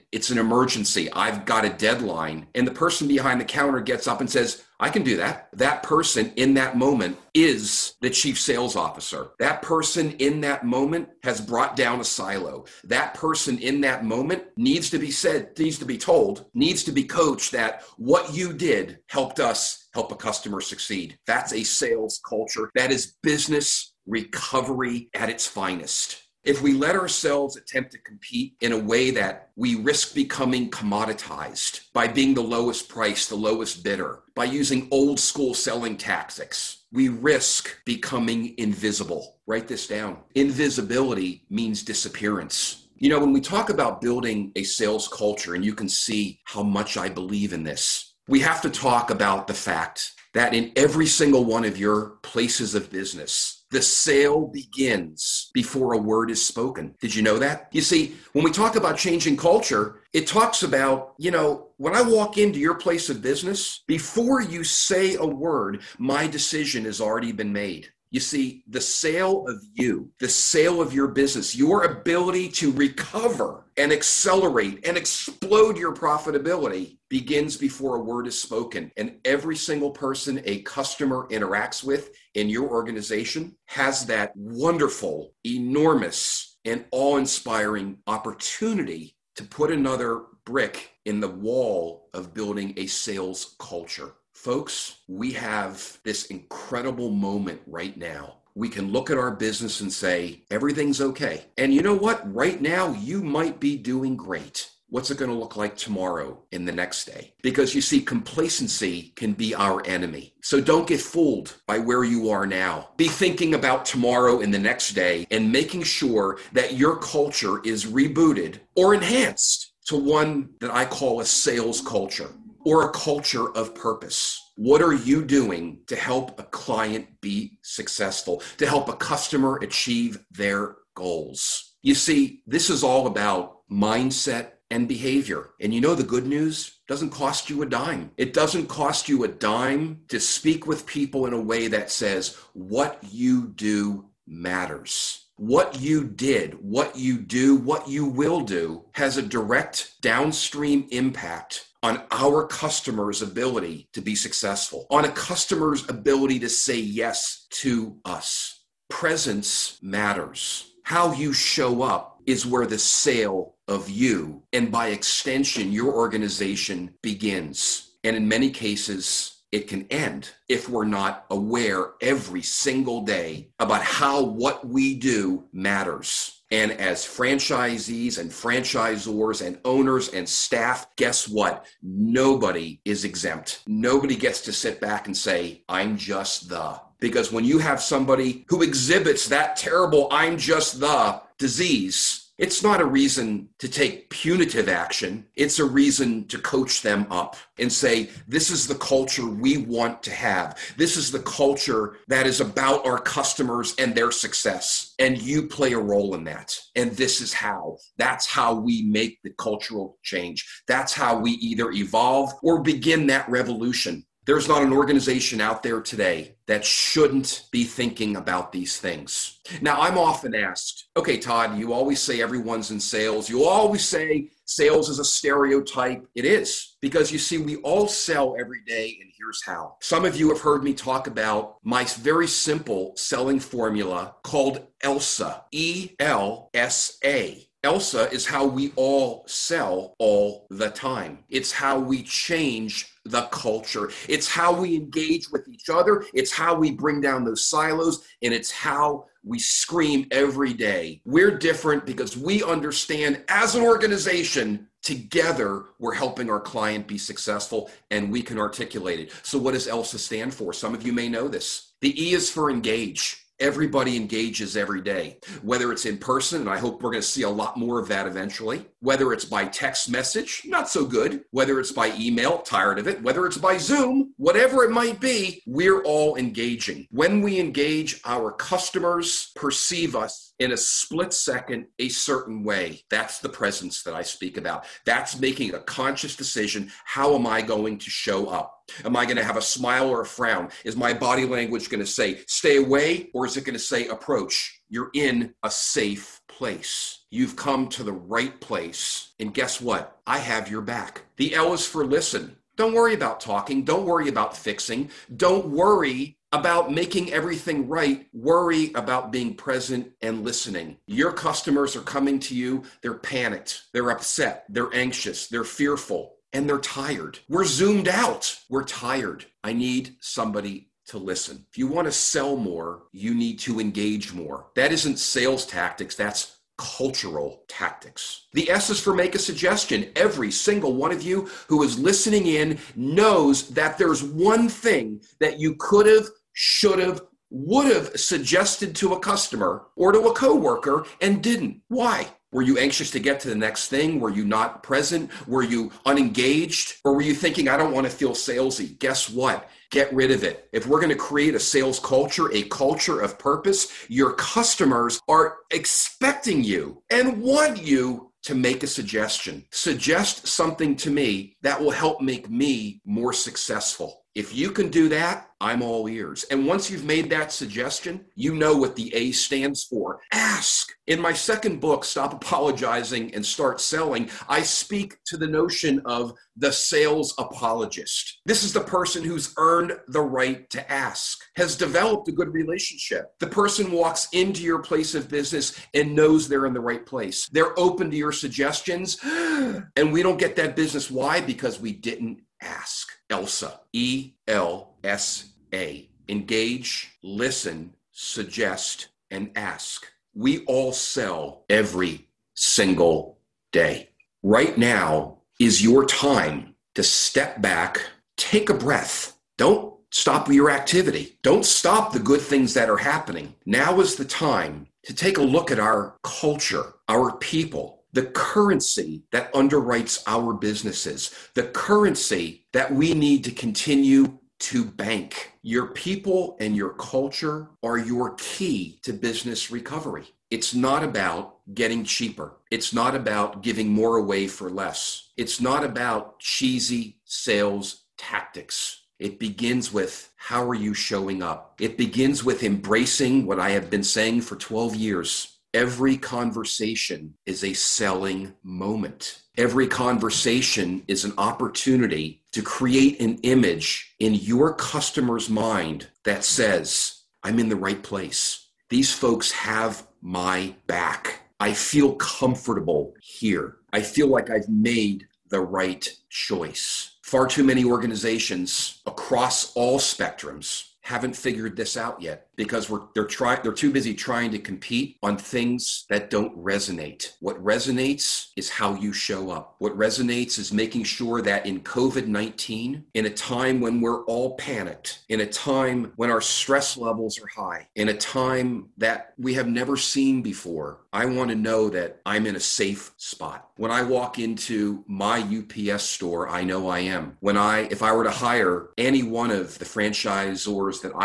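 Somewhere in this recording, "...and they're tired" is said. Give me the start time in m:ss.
5:16.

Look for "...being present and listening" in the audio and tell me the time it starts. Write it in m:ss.
5:09.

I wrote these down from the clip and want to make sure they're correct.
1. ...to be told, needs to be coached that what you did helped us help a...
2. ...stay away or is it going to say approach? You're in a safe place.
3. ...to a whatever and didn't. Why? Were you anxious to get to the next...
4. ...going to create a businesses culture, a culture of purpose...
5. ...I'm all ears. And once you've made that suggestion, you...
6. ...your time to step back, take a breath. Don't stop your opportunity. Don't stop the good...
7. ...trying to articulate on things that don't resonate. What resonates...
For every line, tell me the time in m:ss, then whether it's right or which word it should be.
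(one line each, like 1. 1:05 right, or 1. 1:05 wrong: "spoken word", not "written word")
1. 0:15 right
2. 4:52 right
3. 5:39 wrong: "coworker", not "whatever"
4. 5:50 wrong: "sales", not "businesses"
5. 6:05 right
6. 6:45 wrong: "activity", not "opportunity"
7. 7:53 wrong: "compete", not "articulate".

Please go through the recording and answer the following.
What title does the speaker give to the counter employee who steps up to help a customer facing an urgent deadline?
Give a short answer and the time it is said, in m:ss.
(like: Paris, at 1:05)
Chief sales officer, at 0:08.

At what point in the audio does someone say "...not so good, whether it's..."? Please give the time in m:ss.
4:30.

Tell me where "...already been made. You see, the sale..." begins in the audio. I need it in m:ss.
1:06.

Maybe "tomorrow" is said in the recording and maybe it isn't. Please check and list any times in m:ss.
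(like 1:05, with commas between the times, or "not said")
1:45, 1:53.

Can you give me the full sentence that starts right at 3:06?
Because when you have somebody who exhibits that terrible, I'm just the disease, it's not a reason to take punitive action.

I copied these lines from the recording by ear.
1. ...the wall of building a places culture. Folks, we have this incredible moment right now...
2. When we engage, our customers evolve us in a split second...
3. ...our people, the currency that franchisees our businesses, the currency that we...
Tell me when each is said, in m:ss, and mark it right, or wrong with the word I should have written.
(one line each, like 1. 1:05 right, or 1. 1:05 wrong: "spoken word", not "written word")
1. 1:31 wrong: "sales", not "places"
2. 4:36 wrong: "perceive", not "evolve"
3. 6:56 wrong: "underwrites", not "franchisees".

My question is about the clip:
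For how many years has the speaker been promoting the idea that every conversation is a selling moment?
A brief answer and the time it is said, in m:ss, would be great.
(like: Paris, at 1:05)
12, at 7:24.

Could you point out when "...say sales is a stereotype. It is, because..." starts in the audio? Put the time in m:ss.
3:43.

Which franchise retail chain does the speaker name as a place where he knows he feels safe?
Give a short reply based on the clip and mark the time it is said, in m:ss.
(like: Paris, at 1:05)
UPS Store, at 8:15.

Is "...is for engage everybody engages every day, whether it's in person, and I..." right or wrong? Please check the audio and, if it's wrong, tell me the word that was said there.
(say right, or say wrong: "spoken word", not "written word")
right.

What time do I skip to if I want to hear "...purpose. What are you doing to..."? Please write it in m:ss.
2:03.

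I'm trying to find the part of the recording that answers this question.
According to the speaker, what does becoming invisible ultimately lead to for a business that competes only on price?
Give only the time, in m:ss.
0:41.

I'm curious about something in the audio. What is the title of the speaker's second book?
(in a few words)
Stop Apologizing and Start Selling.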